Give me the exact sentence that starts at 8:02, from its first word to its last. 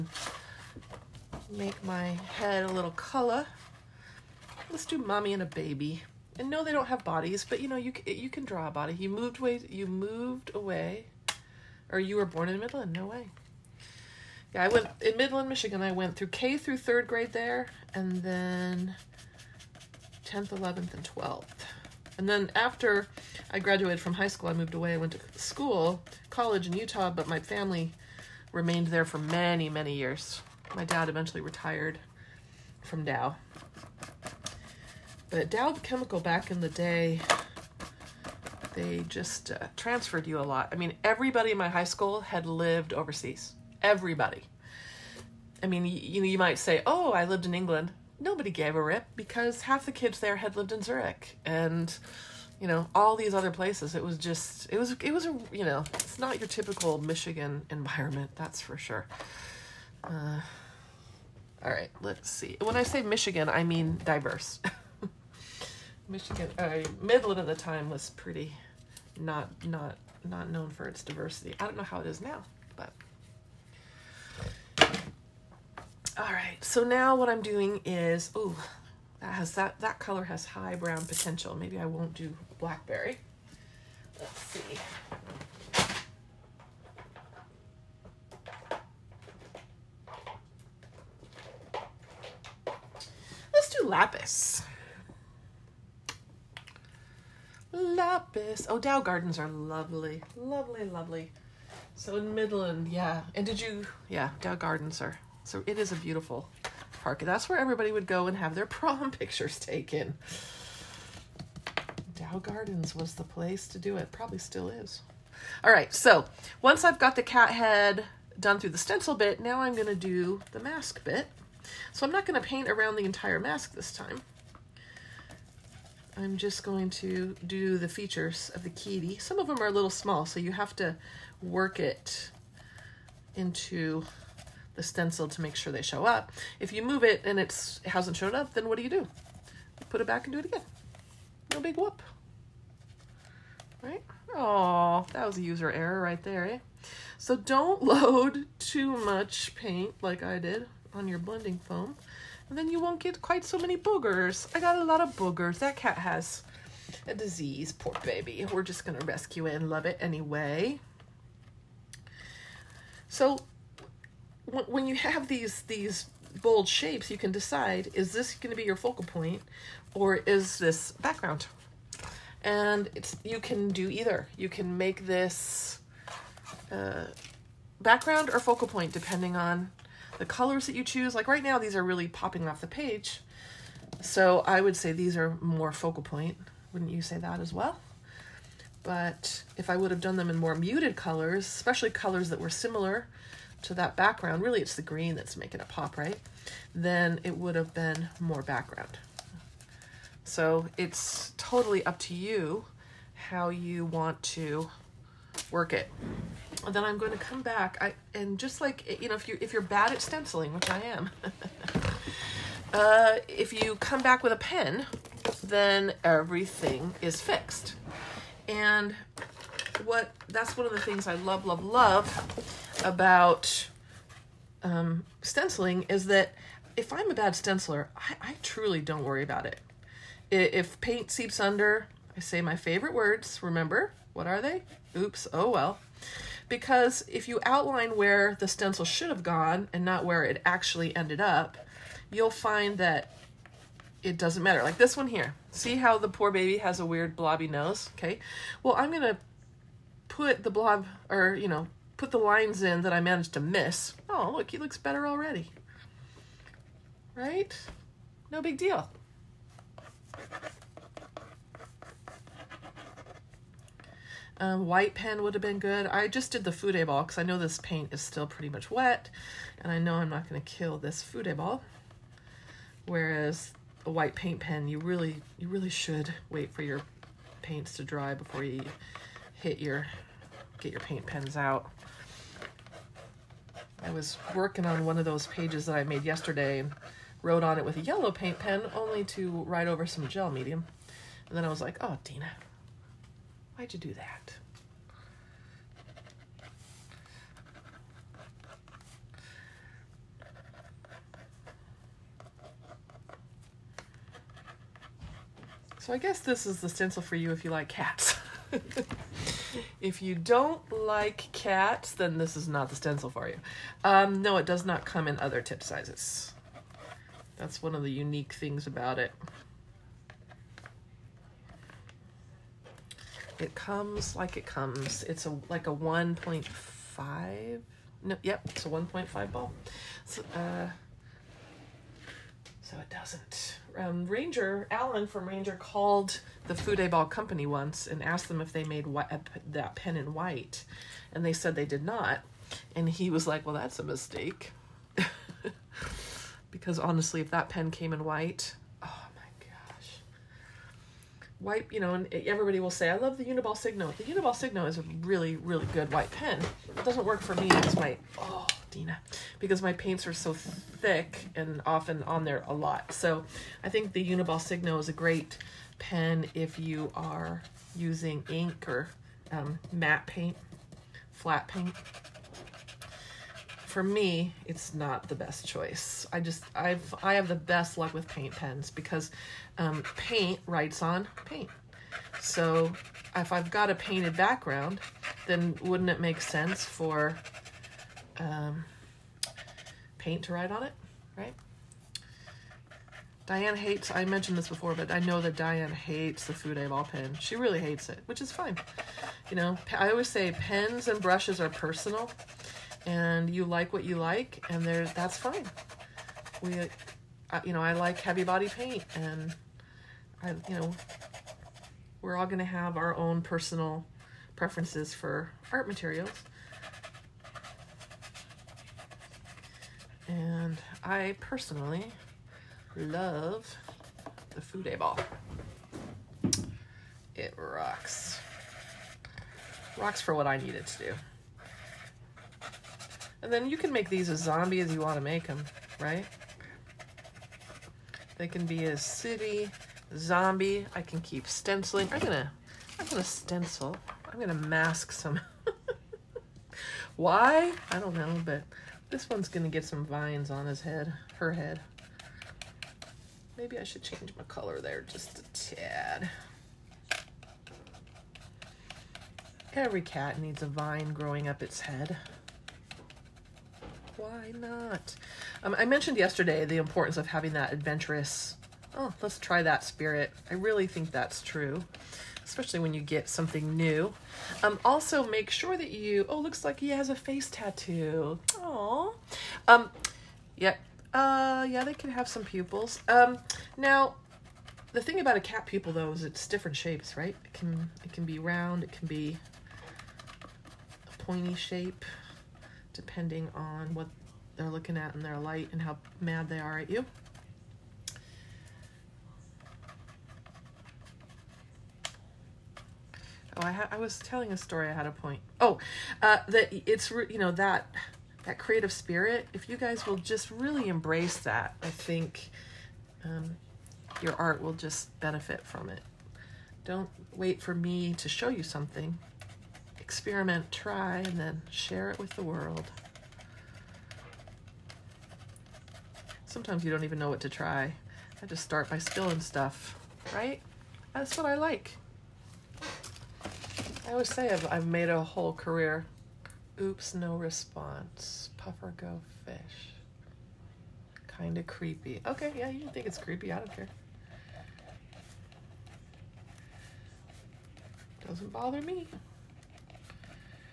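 Um, now, the thing about a cat pupil, though, is it's different shapes, right?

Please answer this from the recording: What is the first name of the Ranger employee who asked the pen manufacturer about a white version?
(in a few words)
Alan.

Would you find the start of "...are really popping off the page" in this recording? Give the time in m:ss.
3:01.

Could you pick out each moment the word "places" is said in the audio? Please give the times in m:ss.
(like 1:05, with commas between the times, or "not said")
0:53, 1:53.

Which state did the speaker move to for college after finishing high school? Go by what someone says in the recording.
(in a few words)
Utah.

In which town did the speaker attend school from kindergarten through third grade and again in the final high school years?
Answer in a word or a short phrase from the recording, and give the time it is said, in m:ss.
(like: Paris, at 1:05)
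Midland, Michigan, at 0:15.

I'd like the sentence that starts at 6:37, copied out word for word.
She really hates it, which is fine.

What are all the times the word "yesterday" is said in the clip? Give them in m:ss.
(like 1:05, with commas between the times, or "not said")
4:46, 7:45.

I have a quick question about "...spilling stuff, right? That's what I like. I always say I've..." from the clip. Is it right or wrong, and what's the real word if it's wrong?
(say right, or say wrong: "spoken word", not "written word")
right.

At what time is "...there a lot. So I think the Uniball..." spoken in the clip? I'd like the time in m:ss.
6:02.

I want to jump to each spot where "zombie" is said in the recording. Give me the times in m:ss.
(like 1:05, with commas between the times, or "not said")
7:14, 7:19.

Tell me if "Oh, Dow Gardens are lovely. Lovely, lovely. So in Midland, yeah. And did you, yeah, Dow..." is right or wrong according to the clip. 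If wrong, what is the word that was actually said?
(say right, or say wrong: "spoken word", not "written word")
right.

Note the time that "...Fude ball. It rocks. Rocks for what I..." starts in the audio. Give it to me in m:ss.
7:04.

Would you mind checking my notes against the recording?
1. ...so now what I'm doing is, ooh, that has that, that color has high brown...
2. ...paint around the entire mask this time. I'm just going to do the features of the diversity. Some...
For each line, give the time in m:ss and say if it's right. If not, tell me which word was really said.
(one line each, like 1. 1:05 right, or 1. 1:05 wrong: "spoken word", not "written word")
1. 1:16 right
2. 2:02 wrong: "kitty", not "diversity".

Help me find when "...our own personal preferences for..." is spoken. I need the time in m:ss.
6:52.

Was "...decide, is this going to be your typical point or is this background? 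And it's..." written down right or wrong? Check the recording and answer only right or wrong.
wrong.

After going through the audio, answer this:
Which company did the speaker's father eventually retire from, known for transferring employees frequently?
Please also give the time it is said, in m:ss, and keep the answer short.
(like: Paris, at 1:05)
Dow Chemical, at 0:35.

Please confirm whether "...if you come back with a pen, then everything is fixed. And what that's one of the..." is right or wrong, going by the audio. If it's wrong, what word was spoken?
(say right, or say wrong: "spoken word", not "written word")
right.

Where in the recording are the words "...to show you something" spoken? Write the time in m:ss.
8:37.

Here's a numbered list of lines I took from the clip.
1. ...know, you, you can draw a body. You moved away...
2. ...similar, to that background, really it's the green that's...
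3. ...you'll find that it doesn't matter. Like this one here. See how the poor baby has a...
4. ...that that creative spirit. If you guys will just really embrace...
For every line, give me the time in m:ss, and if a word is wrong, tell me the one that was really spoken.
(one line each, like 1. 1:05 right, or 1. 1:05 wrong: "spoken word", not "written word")
1. 0:07 right
2. 3:12 right
3. 4:02 right
4. 8:27 right.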